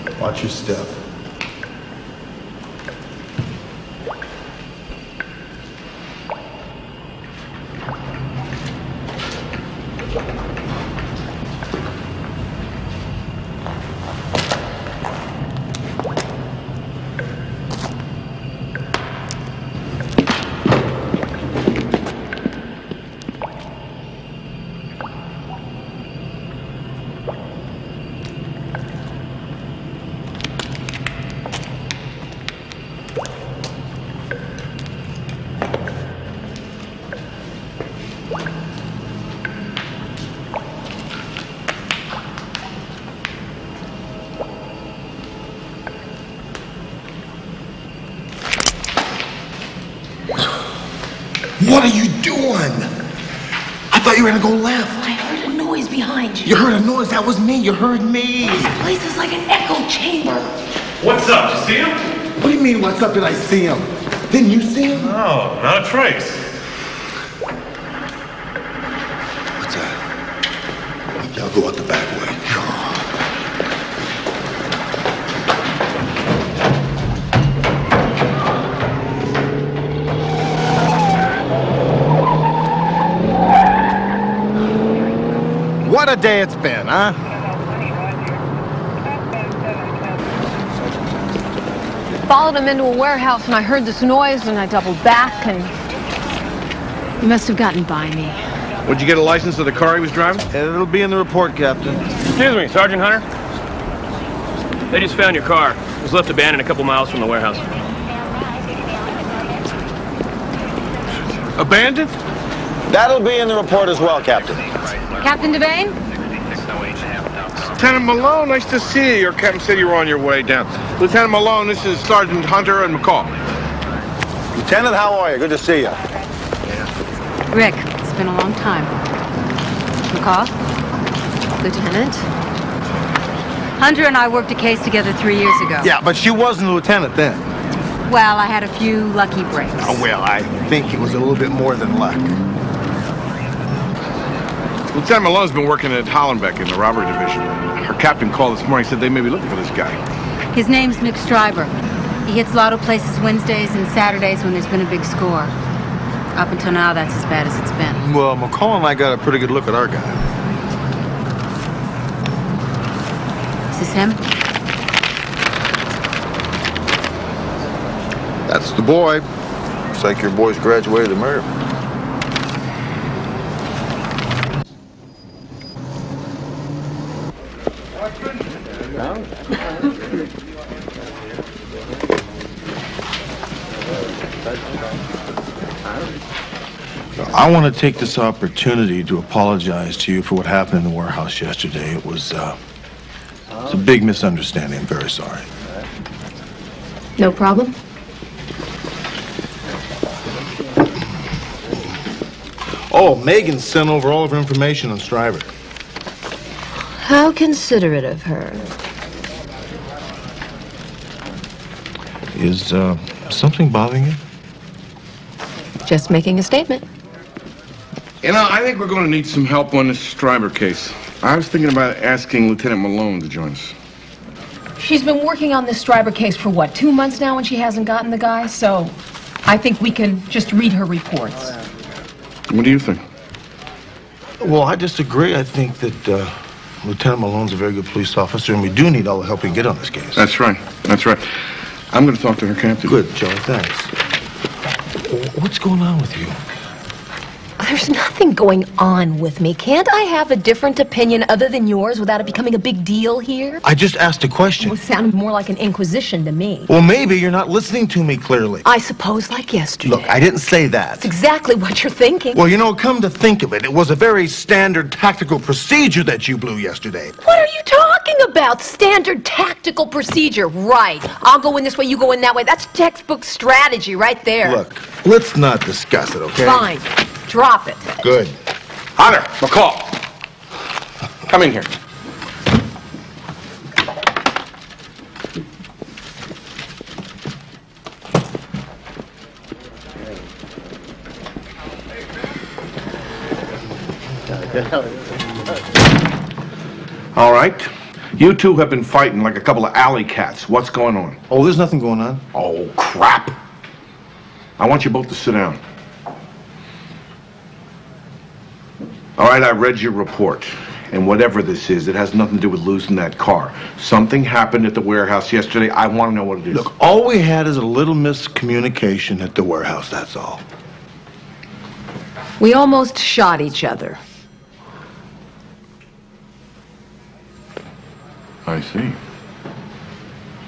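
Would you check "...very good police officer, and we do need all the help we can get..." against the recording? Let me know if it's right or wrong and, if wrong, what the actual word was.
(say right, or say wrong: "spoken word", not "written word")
right.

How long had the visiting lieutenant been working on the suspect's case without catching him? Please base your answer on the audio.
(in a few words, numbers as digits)
Two months.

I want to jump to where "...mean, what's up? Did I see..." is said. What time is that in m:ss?
1:02.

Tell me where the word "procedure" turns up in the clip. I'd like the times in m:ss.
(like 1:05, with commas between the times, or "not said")
4:25, 4:29.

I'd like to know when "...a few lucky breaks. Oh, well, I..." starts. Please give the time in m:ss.
2:18.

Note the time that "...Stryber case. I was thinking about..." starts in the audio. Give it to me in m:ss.
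3:40.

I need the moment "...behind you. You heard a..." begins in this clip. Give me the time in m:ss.
0:55.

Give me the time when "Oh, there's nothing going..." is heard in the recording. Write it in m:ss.
5:01.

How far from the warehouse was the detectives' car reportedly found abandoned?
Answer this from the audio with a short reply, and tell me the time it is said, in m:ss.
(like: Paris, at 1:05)
A couple miles, at 1:46.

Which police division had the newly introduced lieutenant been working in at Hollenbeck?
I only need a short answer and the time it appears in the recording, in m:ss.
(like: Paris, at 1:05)
Robbery division, at 2:26.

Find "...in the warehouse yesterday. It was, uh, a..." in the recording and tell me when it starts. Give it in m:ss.
3:10.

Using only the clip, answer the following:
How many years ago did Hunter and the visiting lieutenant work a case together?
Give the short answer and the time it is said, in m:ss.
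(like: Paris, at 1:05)
3 years, at 2:15.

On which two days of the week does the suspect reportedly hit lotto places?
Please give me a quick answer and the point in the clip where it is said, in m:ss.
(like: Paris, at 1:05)
Wednesdays and Saturdays, at 2:33.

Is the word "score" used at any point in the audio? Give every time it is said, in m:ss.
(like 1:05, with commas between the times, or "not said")
2:35.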